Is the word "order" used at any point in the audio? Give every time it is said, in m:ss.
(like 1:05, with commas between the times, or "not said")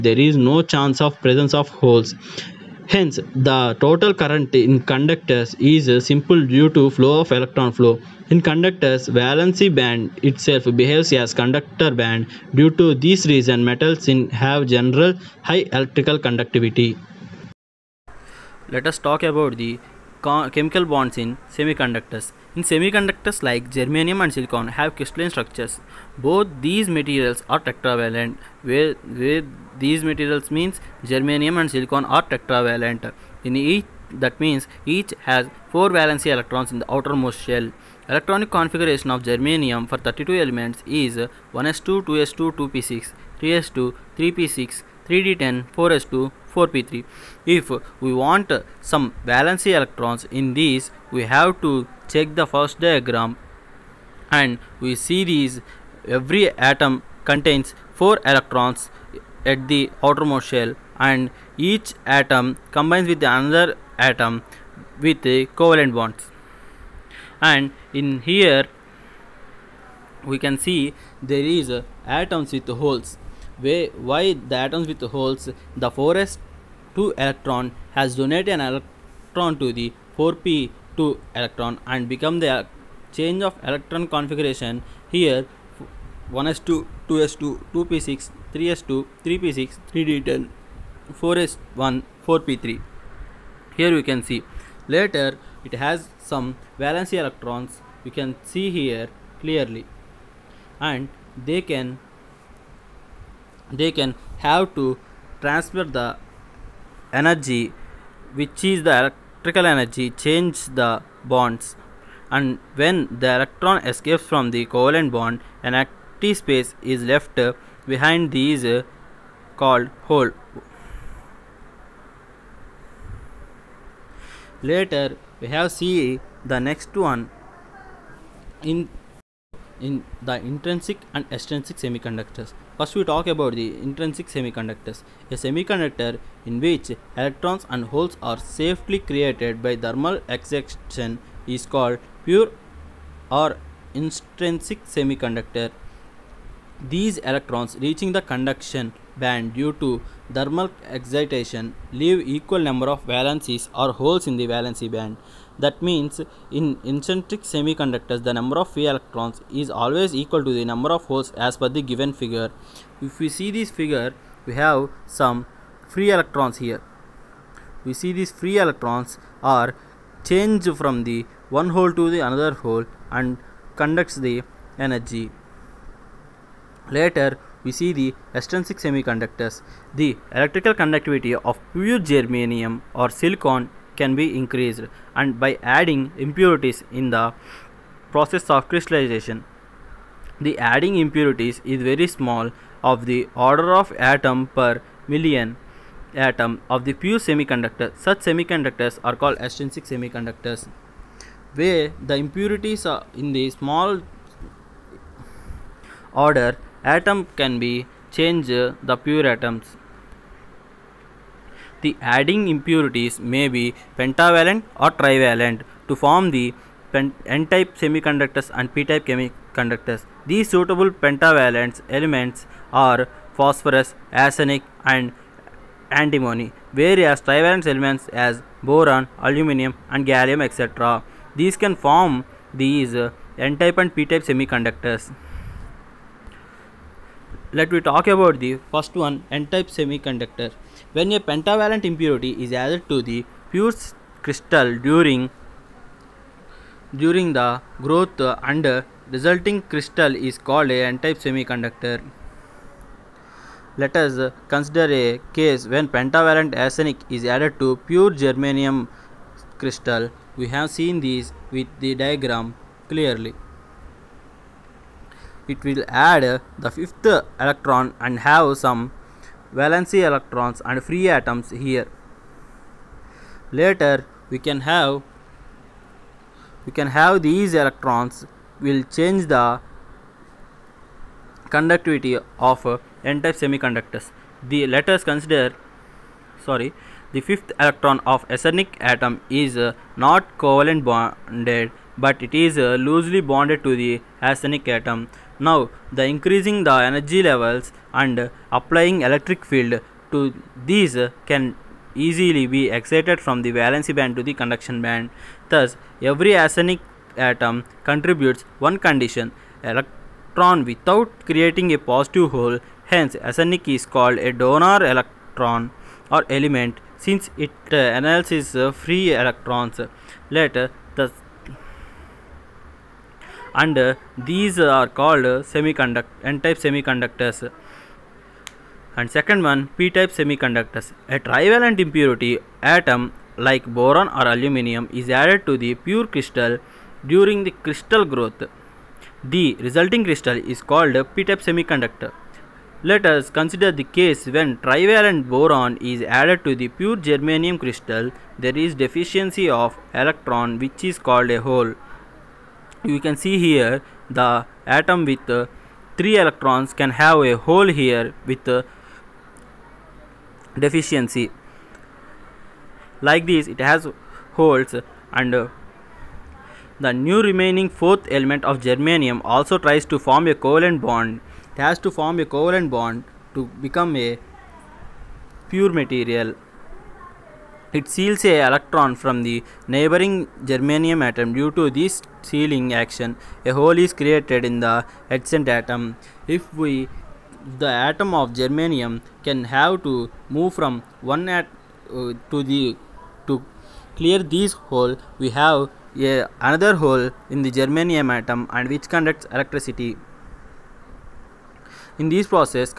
3:13, 3:26.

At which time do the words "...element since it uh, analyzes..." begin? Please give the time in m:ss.
5:16.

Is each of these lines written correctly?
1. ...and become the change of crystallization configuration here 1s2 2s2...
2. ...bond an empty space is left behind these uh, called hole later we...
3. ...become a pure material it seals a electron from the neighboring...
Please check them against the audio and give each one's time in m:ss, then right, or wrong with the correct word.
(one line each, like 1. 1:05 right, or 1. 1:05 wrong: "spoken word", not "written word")
1. 1:21 wrong: "electron", not "crystallization"
2. 1:55 right
3. 6:13 right.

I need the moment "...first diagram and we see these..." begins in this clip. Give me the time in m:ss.
0:52.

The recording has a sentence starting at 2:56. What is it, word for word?
Later, we see the extrinsic semiconductors.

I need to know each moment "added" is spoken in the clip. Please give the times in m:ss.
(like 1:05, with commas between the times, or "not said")
4:02, 4:17, 5:35, 5:46.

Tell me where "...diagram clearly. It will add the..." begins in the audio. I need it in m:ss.
4:21.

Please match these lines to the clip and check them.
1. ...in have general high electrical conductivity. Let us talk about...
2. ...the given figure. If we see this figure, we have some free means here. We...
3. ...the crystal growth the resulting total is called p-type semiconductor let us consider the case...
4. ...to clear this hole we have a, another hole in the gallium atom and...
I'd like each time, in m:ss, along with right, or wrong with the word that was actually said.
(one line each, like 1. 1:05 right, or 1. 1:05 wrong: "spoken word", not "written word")
1. 0:14 right
2. 2:41 wrong: "electrons", not "means"
3. 5:37 wrong: "crystal", not "total"
4. 6:33 wrong: "germanium", not "gallium".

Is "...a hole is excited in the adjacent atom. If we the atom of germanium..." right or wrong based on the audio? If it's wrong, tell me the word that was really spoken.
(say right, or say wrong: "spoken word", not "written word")
wrong: "created", not "excited".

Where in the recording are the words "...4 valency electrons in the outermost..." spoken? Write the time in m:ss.
0:35.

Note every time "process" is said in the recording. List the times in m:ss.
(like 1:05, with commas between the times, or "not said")
3:08, 6:42.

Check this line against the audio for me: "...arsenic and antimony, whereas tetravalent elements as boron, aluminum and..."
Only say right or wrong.
wrong.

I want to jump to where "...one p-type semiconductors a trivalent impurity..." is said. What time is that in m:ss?
5:29.